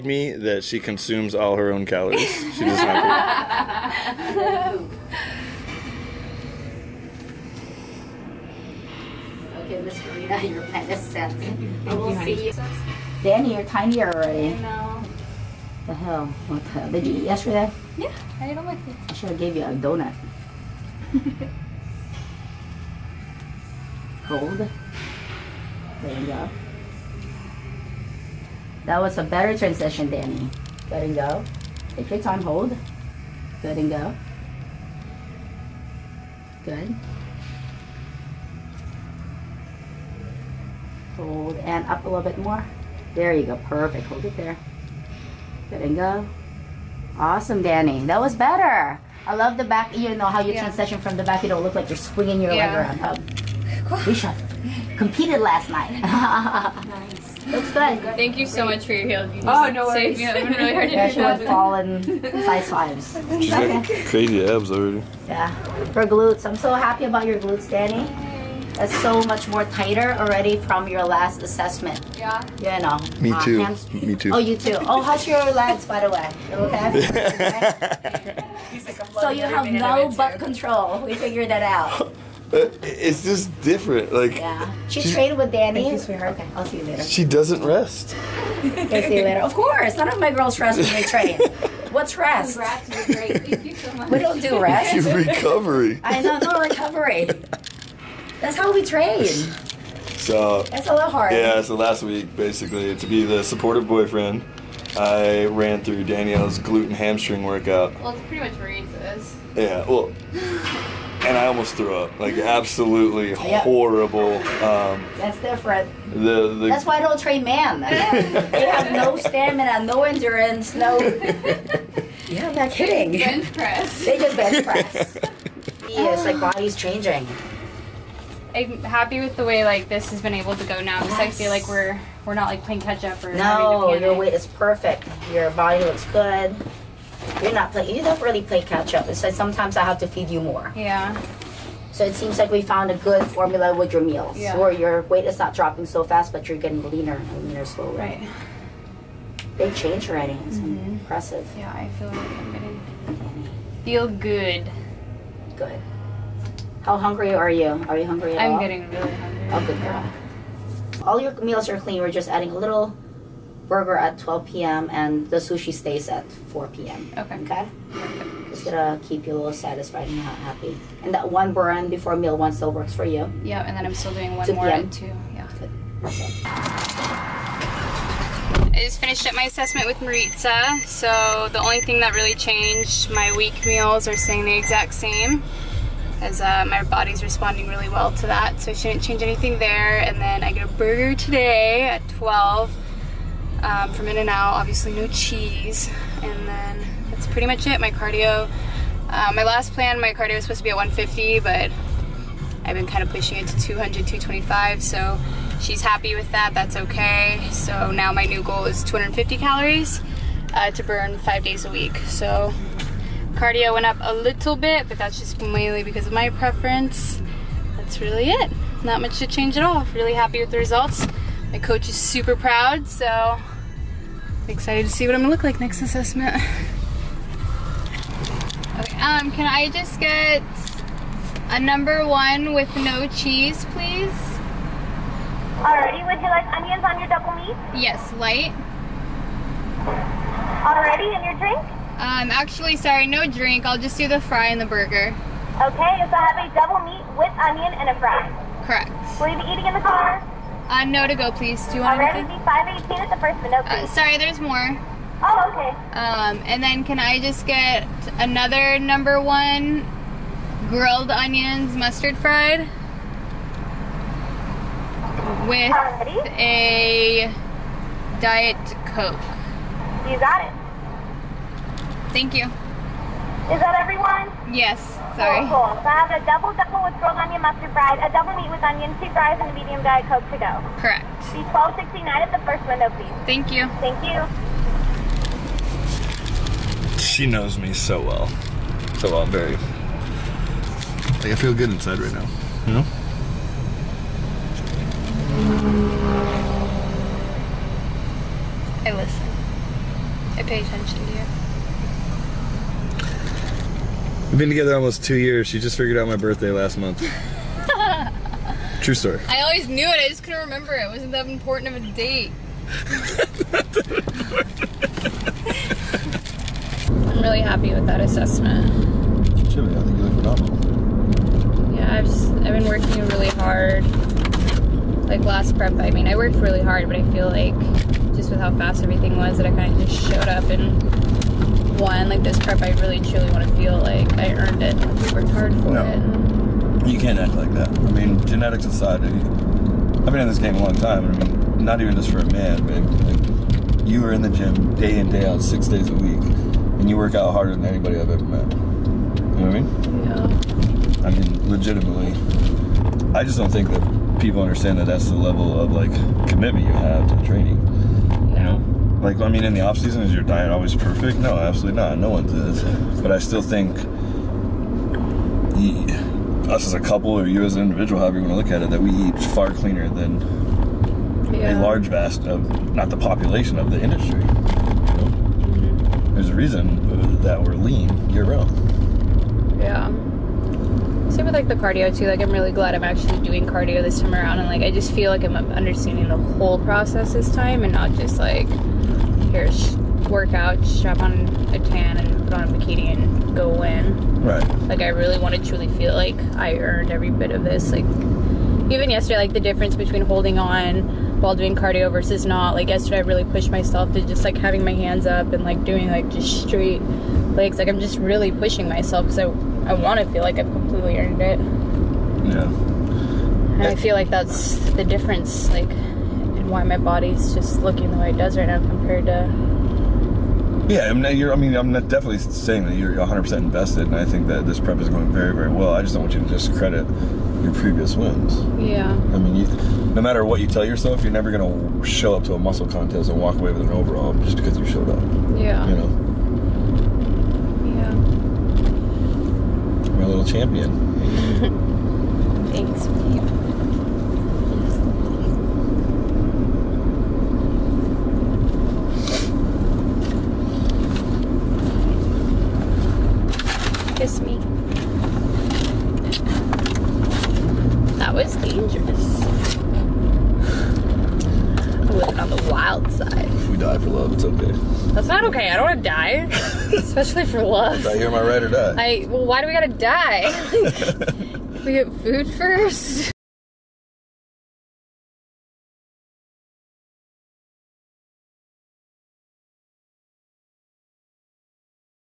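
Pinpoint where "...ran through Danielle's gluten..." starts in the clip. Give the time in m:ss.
1:45.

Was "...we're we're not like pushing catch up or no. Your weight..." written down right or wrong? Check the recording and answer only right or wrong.
wrong.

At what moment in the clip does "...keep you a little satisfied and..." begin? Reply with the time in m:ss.
2:49.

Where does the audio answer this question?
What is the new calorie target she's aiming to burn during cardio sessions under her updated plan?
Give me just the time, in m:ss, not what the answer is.
3:28.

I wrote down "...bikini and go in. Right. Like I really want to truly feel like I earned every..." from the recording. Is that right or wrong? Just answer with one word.
right.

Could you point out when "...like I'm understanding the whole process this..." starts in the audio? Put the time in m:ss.
6:25.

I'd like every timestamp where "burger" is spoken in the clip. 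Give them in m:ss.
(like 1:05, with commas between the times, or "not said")
2:43, 3:10, 4:04.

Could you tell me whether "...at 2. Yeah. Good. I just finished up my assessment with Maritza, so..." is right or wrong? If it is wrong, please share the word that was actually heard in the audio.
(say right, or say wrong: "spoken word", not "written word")
right.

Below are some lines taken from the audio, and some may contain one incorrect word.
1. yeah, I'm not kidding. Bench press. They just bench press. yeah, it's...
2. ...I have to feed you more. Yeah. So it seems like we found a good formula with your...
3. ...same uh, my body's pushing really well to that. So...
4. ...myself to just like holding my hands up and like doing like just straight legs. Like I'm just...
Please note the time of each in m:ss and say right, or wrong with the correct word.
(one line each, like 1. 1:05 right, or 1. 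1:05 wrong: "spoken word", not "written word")
1. 2:02 right
2. 2:19 right
3. 3:04 wrong: "responding", not "pushing"
4. 6:43 wrong: "having", not "holding".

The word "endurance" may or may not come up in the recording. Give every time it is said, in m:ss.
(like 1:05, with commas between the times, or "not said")
2:00.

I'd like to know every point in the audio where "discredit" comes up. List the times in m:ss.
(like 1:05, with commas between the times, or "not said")
7:06.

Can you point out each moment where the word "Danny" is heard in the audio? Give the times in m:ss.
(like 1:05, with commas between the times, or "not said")
0:13, 0:30, 0:47, 1:07, 1:25.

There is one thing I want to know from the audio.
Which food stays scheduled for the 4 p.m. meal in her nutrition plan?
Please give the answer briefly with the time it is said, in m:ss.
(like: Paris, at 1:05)
sushi, at 2:45.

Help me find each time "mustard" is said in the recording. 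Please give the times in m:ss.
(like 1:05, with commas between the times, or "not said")
4:21, 4:37.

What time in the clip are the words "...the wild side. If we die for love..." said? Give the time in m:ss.
7:42.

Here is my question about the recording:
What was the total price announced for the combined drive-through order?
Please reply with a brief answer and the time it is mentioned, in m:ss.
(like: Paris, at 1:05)
$12.69, at 4:41.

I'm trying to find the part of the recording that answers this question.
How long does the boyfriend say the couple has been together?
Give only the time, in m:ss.
5:04.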